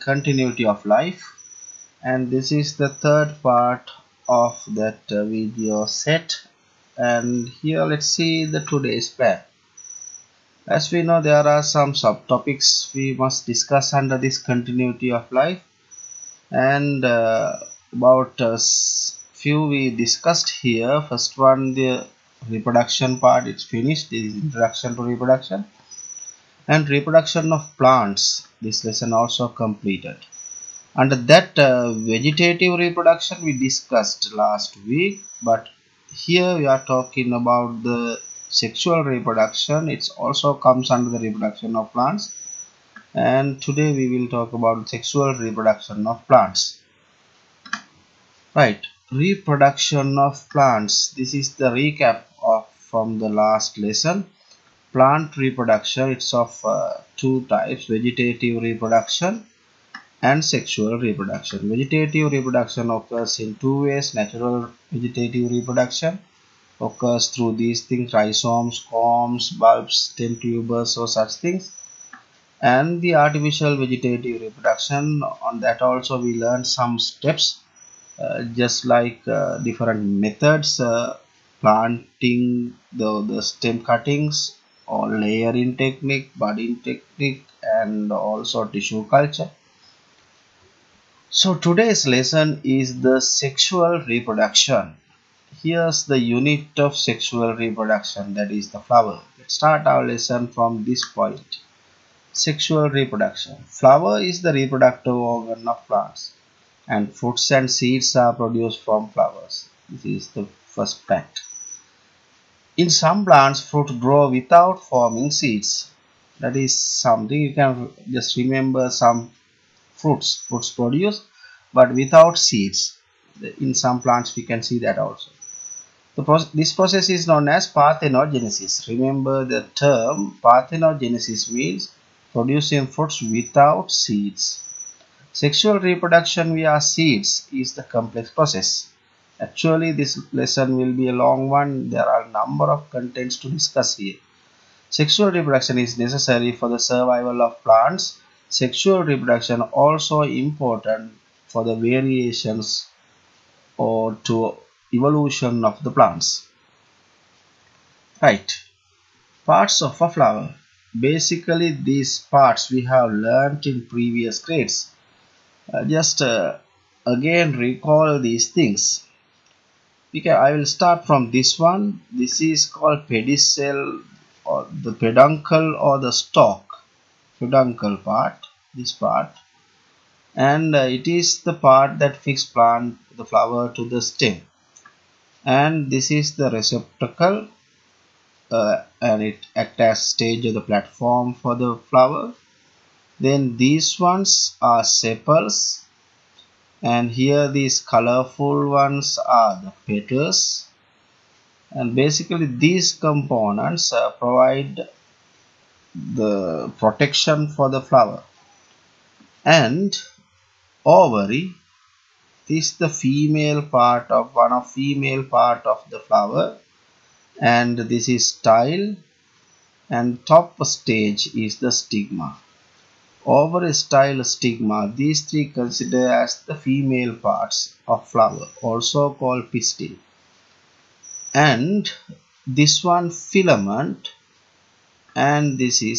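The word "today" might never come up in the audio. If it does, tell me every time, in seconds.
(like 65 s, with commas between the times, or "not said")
8 s, 43 s, 91 s.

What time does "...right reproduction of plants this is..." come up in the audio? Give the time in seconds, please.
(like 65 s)
48 s.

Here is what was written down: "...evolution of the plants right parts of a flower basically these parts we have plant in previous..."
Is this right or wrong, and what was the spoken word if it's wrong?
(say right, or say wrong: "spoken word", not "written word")
wrong: "learnt", not "plant".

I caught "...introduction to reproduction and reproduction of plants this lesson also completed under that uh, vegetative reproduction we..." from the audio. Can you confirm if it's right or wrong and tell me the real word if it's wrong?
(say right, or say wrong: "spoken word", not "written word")
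right.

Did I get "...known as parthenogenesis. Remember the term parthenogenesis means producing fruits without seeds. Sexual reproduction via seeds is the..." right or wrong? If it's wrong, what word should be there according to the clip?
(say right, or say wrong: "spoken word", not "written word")
right.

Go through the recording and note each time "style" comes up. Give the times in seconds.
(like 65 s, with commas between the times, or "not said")
218 s, 223 s.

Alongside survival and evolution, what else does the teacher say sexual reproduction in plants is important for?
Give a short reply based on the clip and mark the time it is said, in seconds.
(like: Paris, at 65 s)
Variations, at 151 s.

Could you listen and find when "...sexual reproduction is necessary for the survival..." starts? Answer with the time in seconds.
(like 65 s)
144 s.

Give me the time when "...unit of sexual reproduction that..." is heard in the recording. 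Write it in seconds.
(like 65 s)
96 s.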